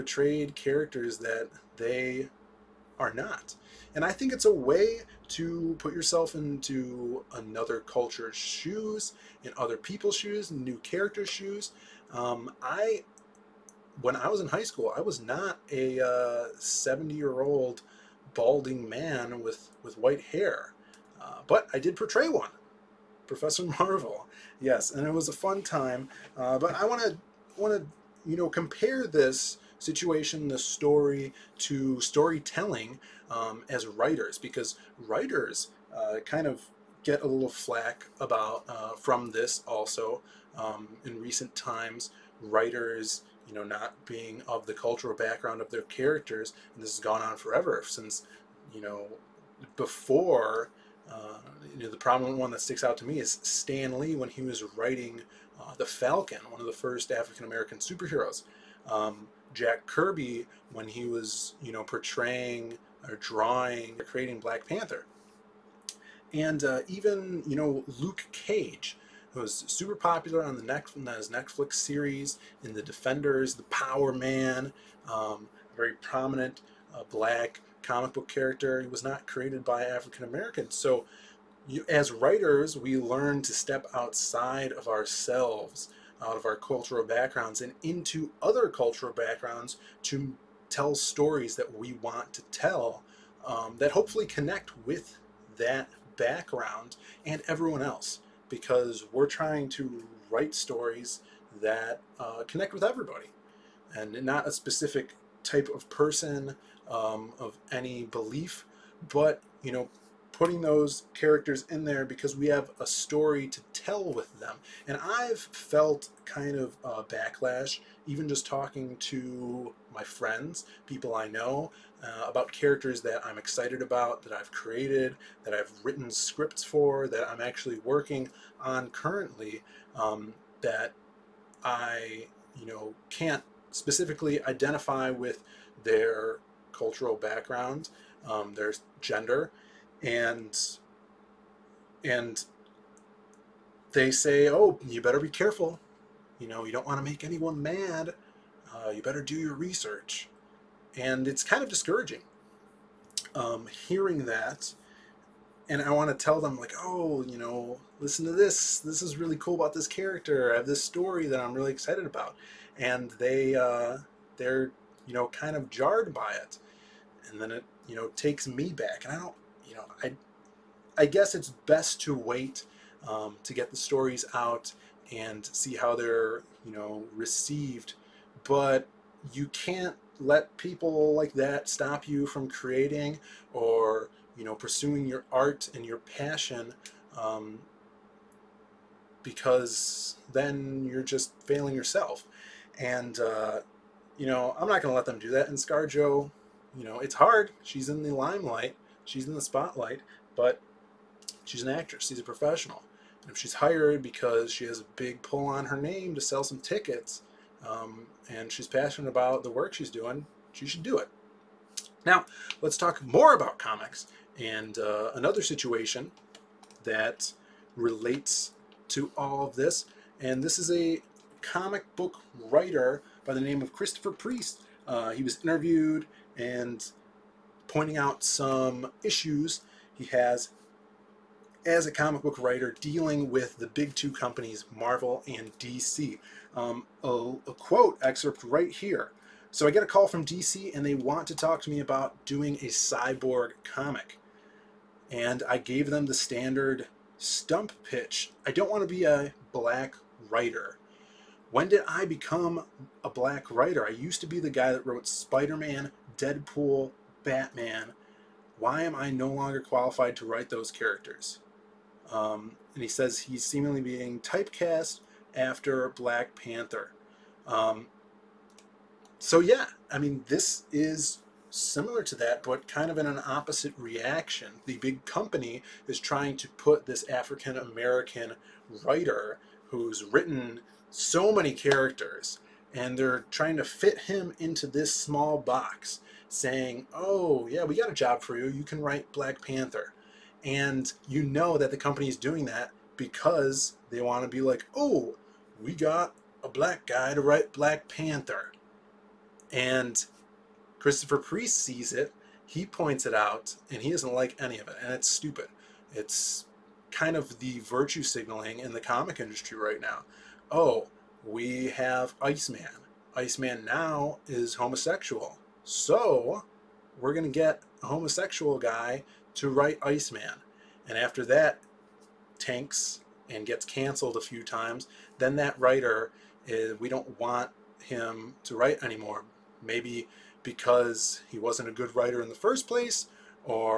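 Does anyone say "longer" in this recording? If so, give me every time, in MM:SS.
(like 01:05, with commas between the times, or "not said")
04:19.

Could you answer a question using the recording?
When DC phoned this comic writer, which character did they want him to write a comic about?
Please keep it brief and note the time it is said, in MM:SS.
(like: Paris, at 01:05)
Cyborg, at 04:02.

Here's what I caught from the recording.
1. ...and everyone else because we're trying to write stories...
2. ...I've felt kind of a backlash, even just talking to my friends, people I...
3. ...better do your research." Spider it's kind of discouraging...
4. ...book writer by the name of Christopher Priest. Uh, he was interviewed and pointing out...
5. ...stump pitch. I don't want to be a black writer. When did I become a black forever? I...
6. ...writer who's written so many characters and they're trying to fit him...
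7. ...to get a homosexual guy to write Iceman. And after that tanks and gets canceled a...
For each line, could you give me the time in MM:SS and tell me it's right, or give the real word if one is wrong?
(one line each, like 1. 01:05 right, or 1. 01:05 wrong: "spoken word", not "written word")
1. 01:37 right
2. 01:55 right
3. 02:29 wrong: "And", not "Spider"
4. 03:41 right
5. 04:07 wrong: "writer", not "forever"
6. 04:38 right
7. 05:17 right.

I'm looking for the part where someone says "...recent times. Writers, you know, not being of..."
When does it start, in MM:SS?
00:41.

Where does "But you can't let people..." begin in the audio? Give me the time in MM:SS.
02:58.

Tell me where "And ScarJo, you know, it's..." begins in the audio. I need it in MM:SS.
03:15.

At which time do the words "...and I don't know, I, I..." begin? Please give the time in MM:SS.
02:49.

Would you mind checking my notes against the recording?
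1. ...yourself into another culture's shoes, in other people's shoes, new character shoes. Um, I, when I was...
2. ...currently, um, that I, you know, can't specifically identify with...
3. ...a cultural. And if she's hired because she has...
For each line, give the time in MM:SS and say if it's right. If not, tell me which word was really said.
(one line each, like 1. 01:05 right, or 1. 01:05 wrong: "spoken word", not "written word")
1. 00:05 right
2. 02:08 right
3. 03:22 wrong: "professional", not "cultural".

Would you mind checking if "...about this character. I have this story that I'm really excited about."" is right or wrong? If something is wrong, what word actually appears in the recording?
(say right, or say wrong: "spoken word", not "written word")
right.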